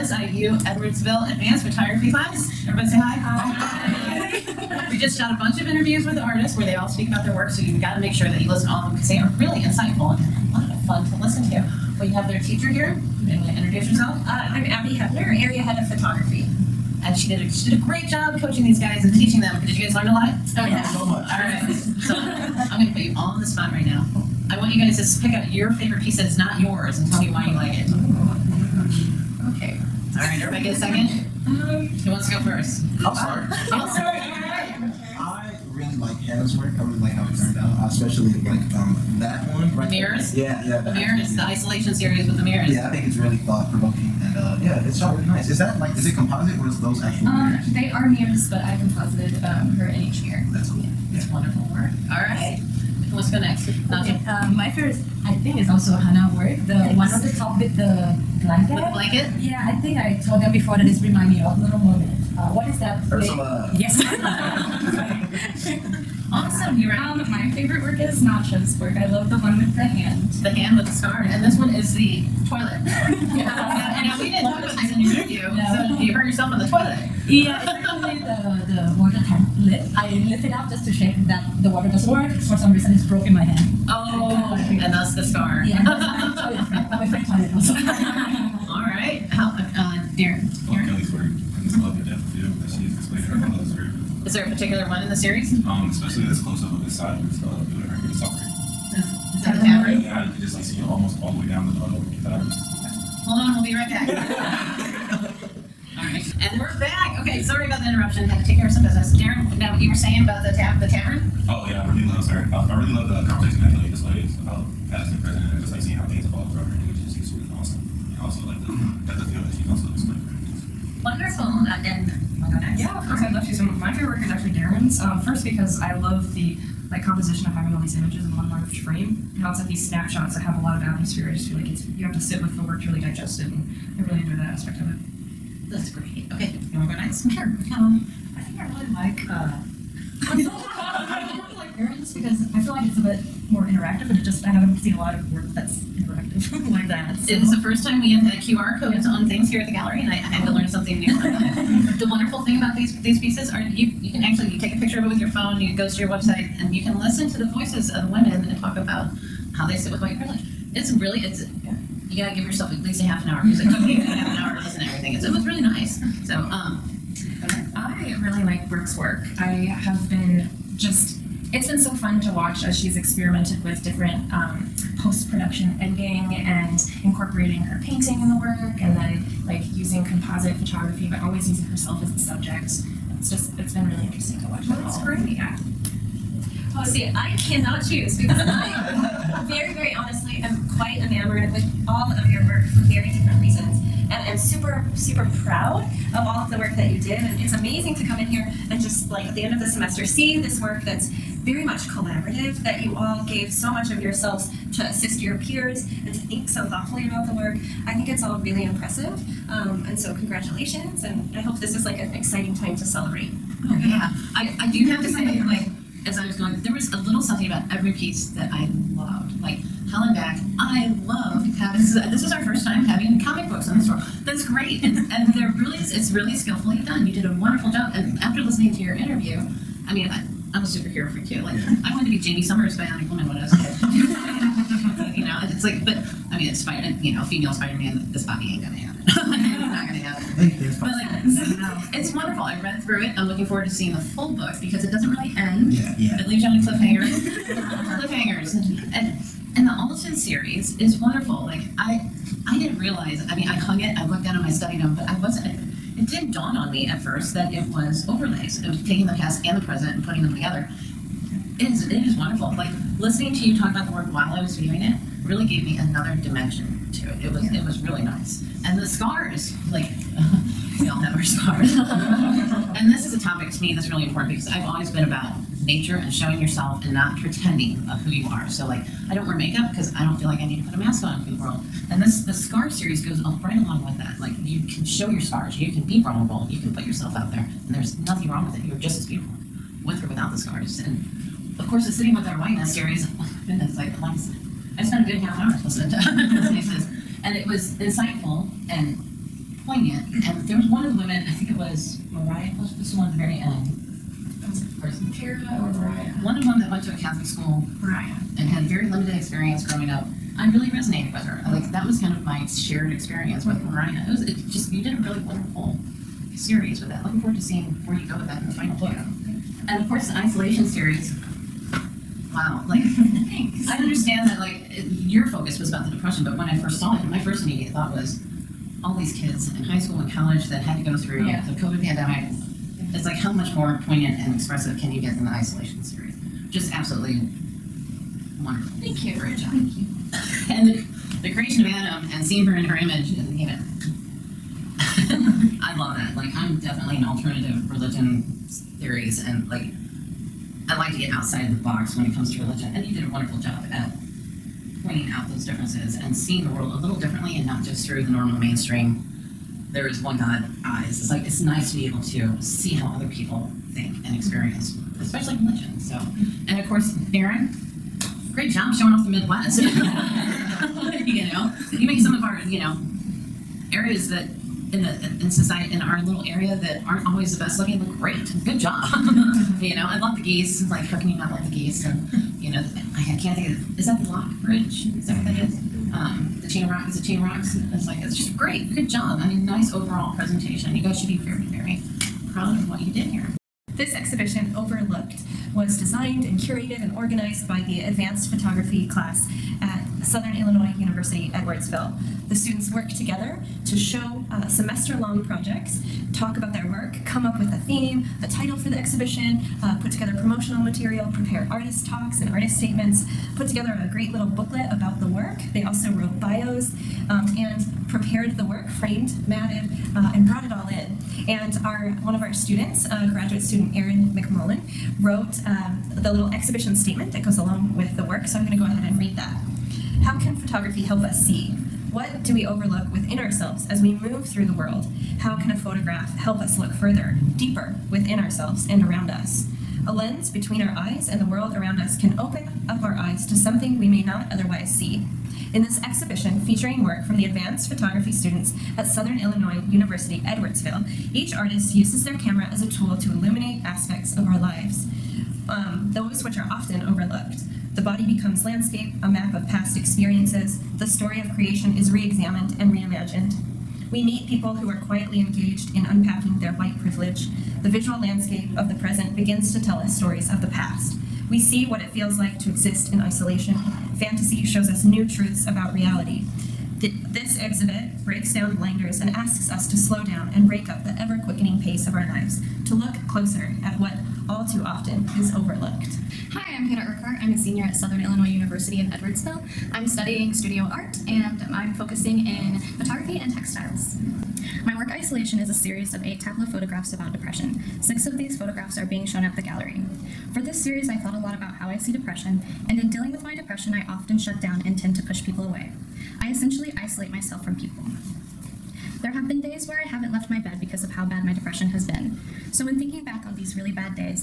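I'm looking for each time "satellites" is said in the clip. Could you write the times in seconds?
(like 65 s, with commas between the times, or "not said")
not said.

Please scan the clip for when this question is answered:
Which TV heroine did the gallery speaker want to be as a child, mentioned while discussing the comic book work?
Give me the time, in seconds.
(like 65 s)
232 s.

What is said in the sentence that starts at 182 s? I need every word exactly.
It's just, it's been really interesting to watch.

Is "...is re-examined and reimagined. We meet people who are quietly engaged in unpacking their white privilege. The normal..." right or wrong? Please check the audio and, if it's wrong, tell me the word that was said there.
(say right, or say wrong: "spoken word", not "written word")
wrong: "visual", not "normal".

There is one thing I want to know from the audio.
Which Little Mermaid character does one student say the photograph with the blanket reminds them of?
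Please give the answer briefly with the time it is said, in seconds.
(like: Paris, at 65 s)
Ursula, at 63 s.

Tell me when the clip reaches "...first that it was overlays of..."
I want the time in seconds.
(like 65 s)
256 s.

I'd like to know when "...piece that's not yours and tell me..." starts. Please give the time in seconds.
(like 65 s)
26 s.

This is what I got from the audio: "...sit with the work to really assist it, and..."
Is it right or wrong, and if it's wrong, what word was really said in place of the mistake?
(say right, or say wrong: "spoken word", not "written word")
wrong: "digest", not "assist".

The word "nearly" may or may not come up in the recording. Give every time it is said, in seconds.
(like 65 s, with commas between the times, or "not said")
not said.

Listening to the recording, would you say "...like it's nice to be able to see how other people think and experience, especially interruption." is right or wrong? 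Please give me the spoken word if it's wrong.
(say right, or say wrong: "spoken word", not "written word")
wrong: "religion", not "interruption".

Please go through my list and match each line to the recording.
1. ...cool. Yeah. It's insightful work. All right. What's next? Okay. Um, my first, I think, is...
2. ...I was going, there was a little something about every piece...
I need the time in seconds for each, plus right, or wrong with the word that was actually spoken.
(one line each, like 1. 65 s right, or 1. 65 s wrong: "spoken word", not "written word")
1. 50 s wrong: "wonderful", not "insightful"
2. 216 s right.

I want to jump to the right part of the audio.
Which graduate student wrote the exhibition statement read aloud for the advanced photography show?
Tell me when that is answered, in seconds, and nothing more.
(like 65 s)
423 s.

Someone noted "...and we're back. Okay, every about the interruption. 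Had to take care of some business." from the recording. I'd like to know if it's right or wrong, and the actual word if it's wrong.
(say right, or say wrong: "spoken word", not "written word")
wrong: "sorry", not "every".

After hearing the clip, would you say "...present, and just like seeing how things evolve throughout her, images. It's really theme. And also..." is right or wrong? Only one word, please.
wrong.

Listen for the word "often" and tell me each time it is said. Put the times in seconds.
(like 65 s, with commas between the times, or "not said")
456 s, 484 s, 503 s.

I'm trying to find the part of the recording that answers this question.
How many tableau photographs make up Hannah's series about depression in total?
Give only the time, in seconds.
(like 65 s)
496 s.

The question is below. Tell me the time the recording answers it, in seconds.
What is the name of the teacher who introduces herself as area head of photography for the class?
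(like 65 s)
14 s.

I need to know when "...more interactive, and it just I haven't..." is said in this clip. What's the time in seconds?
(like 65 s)
143 s.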